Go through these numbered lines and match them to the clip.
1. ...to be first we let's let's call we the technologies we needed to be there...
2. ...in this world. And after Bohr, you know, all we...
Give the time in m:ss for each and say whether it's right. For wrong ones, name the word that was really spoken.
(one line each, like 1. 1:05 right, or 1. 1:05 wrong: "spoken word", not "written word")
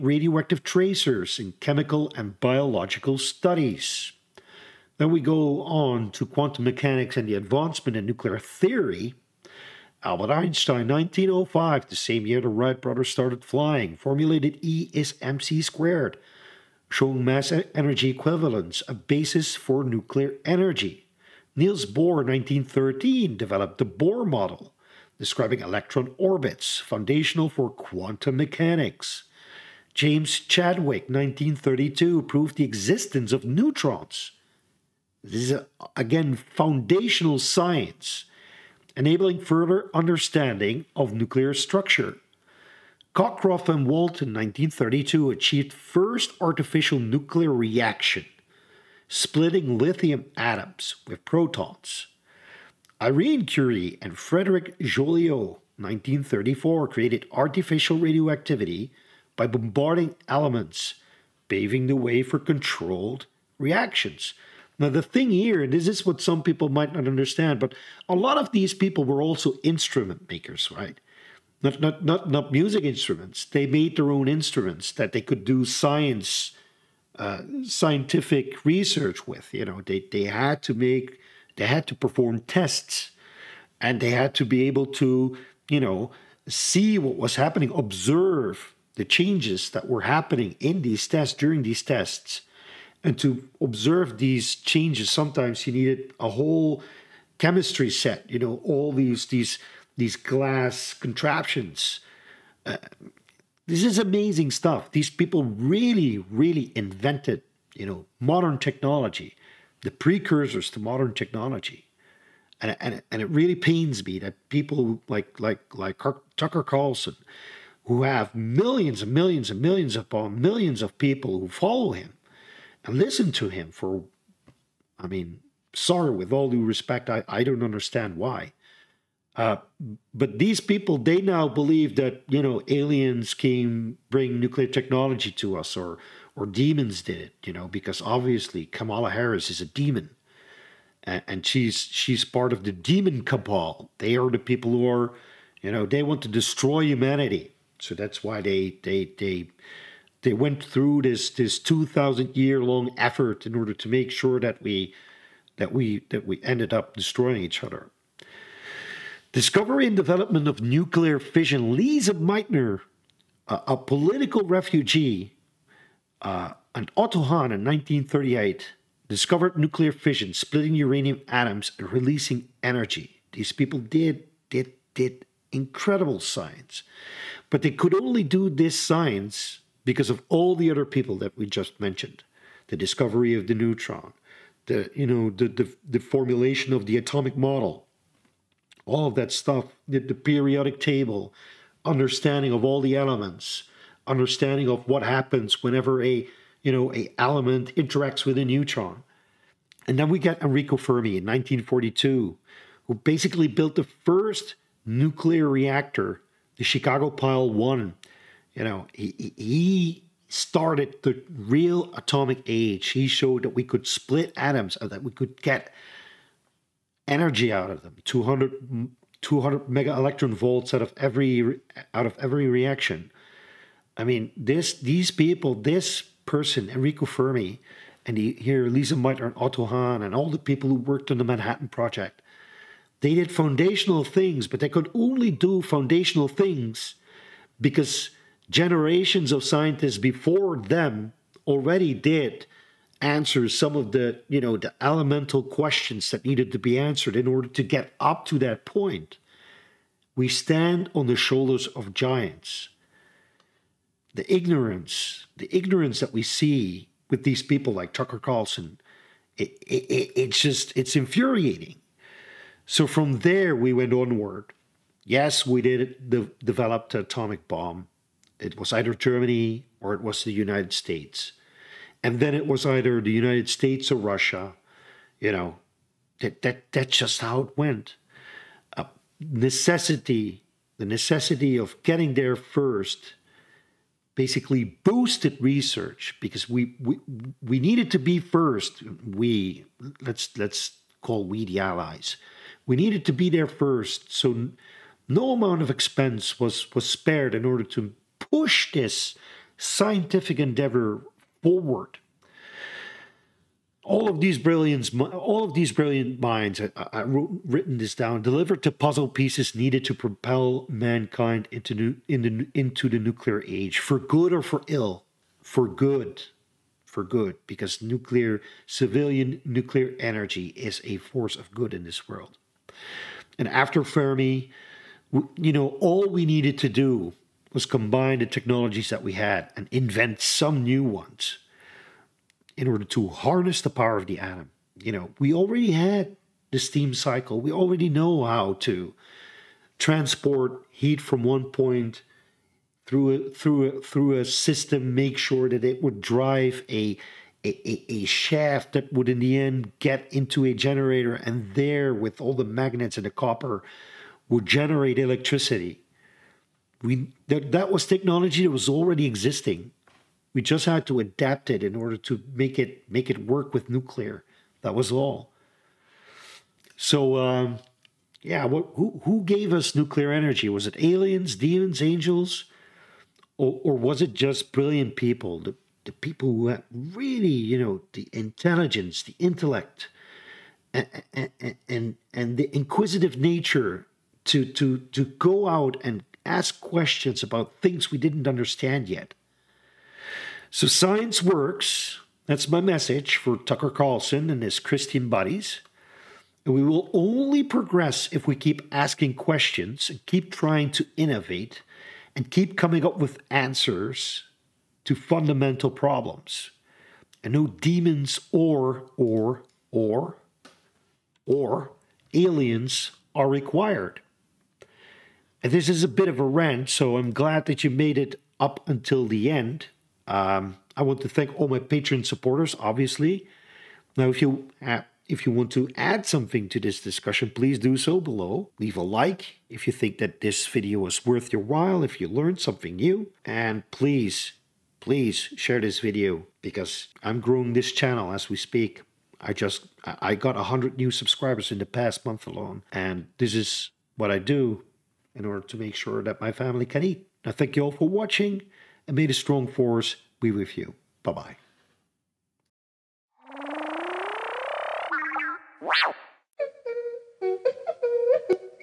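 1. 4:47 wrong: "allies", not "technologies"
2. 5:21 wrong: "Fermi", not "Bohr".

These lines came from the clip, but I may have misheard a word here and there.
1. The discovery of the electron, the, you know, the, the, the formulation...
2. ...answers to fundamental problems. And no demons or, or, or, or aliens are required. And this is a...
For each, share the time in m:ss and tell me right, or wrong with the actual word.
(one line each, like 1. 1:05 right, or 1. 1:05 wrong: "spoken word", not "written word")
1. 3:02 wrong: "neutron", not "electron"
2. 6:43 right.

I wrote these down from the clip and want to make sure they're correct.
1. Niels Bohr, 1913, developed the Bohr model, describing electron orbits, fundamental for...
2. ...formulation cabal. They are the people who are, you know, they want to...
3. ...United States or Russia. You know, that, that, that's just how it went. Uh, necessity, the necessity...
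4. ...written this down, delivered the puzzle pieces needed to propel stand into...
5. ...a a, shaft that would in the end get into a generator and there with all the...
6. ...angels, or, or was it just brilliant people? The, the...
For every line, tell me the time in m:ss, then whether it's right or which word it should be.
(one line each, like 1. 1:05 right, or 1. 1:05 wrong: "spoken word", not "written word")
1. 0:21 wrong: "foundational", not "fundamental"
2. 2:22 wrong: "demon", not "formulation"
3. 4:33 right
4. 5:07 wrong: "mankind", not "stand"
5. 5:47 right
6. 6:11 right.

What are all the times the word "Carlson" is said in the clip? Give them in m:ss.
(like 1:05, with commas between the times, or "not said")
1:56, 4:18, 6:33.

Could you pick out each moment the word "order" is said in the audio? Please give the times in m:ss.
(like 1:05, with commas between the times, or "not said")
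2:33, 4:07, 4:57, 5:32, 6:01, 7:25.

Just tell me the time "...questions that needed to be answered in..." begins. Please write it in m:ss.
4:05.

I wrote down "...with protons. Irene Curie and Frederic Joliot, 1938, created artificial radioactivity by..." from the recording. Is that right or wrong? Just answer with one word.
wrong.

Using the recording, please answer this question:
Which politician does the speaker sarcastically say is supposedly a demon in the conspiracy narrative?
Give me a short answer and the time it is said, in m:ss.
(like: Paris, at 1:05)
Kamala Harris, at 2:18.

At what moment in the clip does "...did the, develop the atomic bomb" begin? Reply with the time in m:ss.
4:25.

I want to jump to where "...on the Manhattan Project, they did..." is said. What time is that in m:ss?
3:51.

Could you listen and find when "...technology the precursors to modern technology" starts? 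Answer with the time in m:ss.
1:48.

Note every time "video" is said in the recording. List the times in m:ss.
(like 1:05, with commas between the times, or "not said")
7:10, 7:15.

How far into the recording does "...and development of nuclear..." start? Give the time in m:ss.
2:39.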